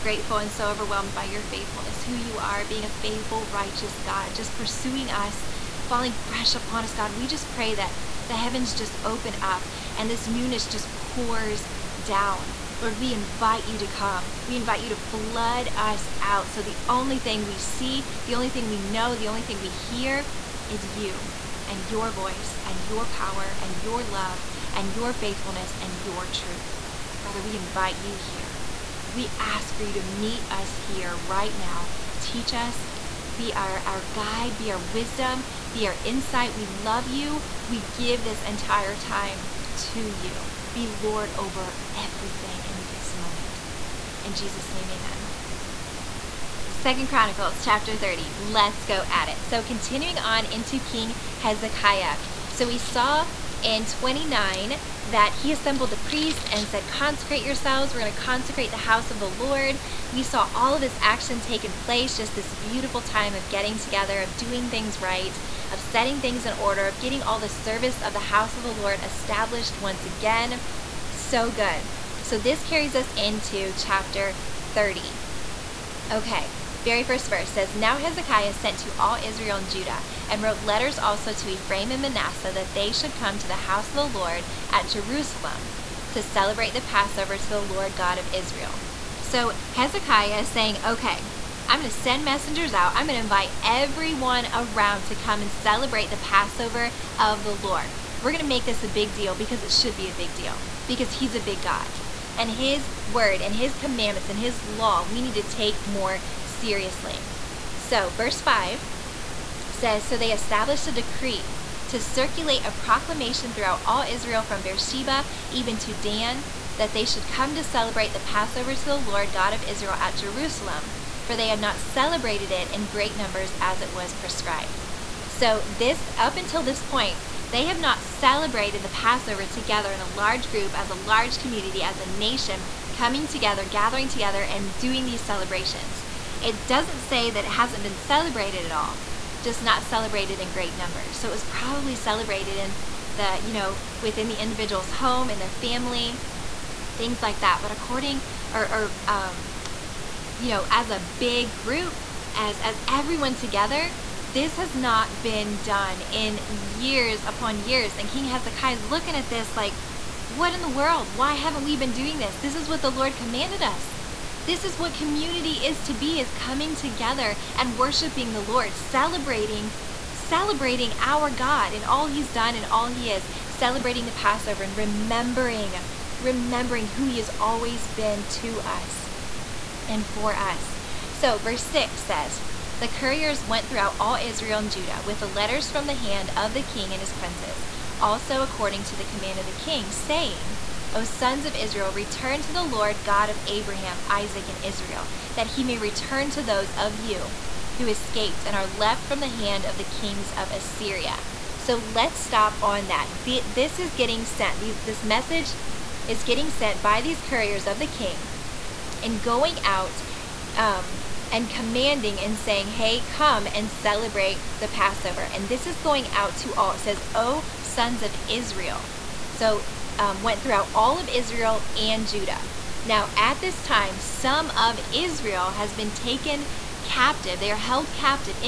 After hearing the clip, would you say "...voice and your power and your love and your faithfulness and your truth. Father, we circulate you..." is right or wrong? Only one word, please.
wrong.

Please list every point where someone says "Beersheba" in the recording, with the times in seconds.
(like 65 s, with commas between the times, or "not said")
114 s.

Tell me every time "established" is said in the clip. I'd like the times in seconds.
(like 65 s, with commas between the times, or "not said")
69 s, 110 s.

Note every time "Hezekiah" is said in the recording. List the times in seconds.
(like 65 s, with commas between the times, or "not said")
51 s, 77 s, 89 s, 158 s.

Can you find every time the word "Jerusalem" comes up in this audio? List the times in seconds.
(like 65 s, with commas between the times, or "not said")
84 s, 120 s.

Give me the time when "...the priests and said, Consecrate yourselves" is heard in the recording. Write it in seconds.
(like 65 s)
55 s.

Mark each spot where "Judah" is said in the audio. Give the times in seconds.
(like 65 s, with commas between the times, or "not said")
79 s, 184 s, 222 s.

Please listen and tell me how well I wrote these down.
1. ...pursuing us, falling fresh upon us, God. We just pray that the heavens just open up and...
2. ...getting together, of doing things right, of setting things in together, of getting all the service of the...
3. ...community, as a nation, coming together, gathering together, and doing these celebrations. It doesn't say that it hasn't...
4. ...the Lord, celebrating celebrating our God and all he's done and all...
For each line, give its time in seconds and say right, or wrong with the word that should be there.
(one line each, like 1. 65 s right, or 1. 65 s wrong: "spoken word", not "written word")
1. 4 s right
2. 63 s wrong: "order", not "together"
3. 131 s right
4. 168 s right.